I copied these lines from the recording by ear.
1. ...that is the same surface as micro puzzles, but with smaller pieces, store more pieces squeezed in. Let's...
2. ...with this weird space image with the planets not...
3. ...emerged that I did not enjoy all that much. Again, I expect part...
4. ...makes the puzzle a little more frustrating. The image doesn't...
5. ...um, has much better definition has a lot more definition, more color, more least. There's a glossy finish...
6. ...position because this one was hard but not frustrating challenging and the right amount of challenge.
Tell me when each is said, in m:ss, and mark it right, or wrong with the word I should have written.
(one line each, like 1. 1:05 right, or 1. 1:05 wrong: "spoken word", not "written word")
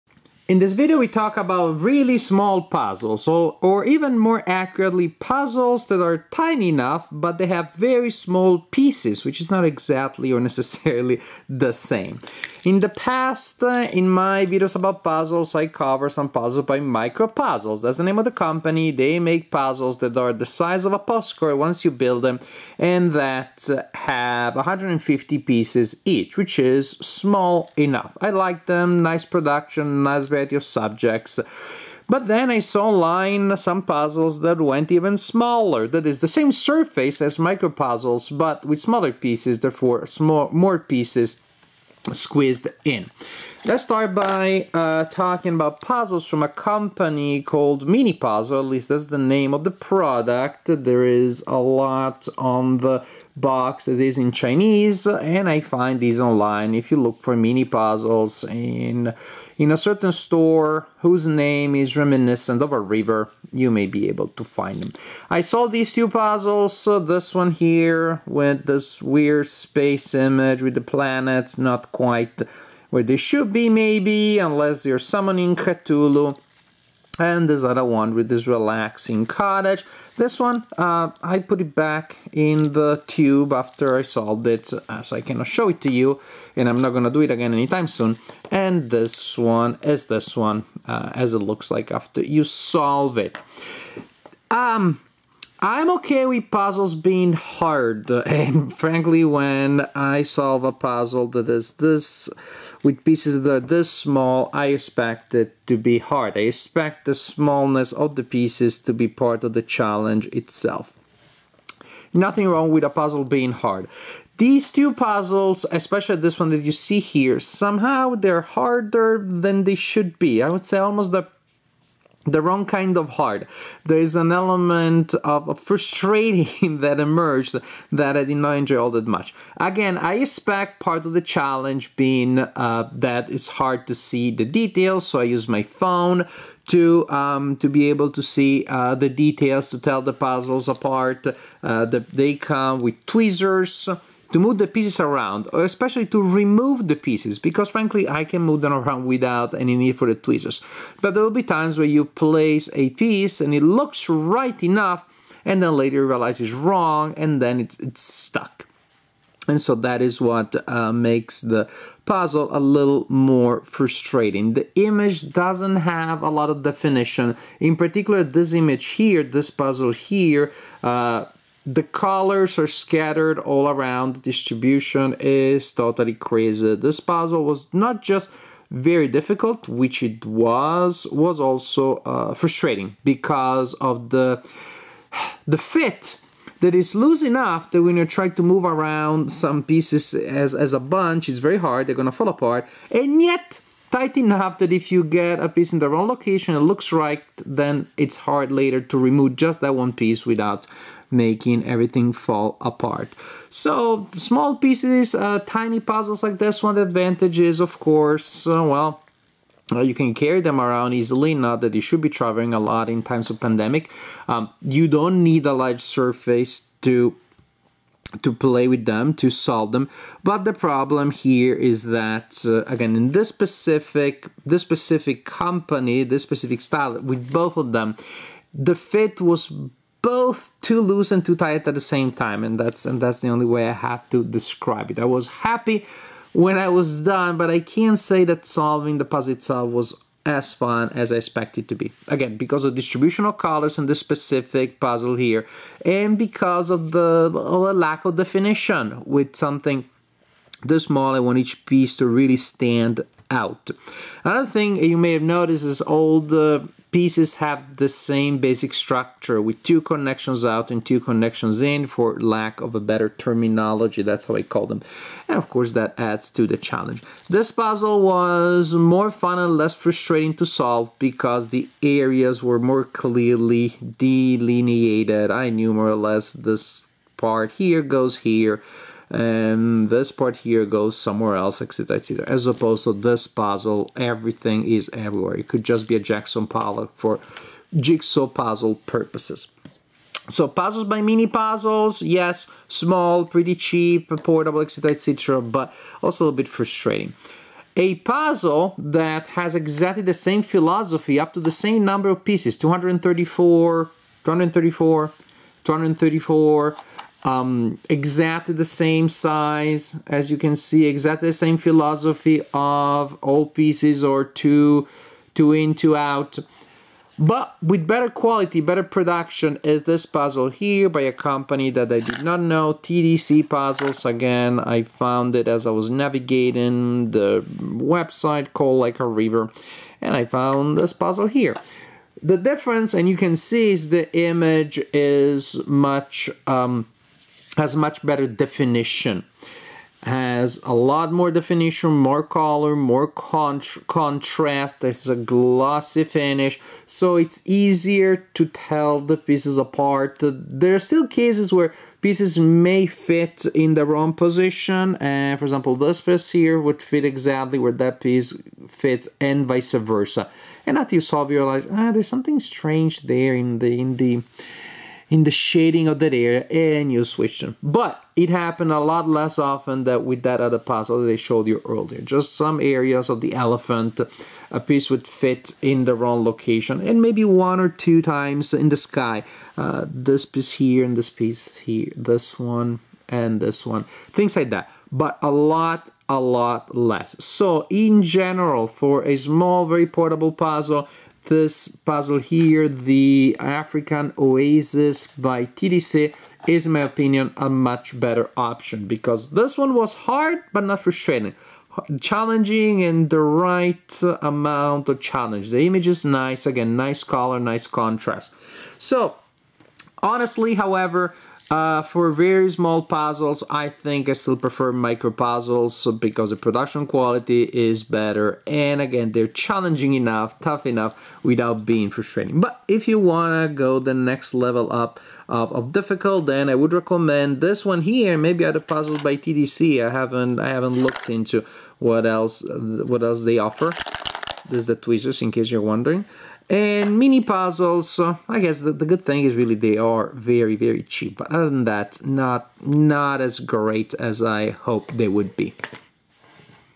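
1. 0:35 wrong: "therefore", not "store"
2. 1:08 right
3. 2:06 right
4. 2:40 right
5. 5:36 wrong: "contrast", not "least"
6. 6:38 wrong: "option", not "position".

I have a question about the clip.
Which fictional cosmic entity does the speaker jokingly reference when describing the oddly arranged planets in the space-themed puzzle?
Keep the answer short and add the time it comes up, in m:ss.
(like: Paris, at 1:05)
Cthulhu, at 1:15.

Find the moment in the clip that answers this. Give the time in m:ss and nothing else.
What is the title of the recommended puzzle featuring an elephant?
6:33.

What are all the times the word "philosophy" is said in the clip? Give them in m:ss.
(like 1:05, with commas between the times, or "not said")
5:00, 5:11.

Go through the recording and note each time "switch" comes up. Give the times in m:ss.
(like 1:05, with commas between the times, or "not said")
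6:07.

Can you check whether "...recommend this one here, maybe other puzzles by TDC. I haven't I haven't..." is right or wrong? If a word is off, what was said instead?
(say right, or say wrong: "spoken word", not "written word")
right.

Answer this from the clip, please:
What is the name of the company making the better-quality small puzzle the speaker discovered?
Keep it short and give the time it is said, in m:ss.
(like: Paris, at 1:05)
TDC Puzzles, at 5:22.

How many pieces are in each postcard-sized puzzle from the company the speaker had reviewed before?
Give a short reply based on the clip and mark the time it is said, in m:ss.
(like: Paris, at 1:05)
150, at 0:24.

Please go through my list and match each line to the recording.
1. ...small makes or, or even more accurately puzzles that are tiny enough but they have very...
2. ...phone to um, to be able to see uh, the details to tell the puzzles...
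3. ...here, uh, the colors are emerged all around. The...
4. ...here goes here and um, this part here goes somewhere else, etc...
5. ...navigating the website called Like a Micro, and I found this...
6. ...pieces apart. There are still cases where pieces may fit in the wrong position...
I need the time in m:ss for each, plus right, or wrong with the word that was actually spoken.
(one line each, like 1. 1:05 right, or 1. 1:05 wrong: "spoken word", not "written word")
1. 0:02 wrong: "puzzles", not "makes"
2. 2:15 right
3. 2:49 wrong: "scattered", not "emerged"
4. 4:37 right
5. 5:25 wrong: "River", not "Micro"
6. 5:49 right.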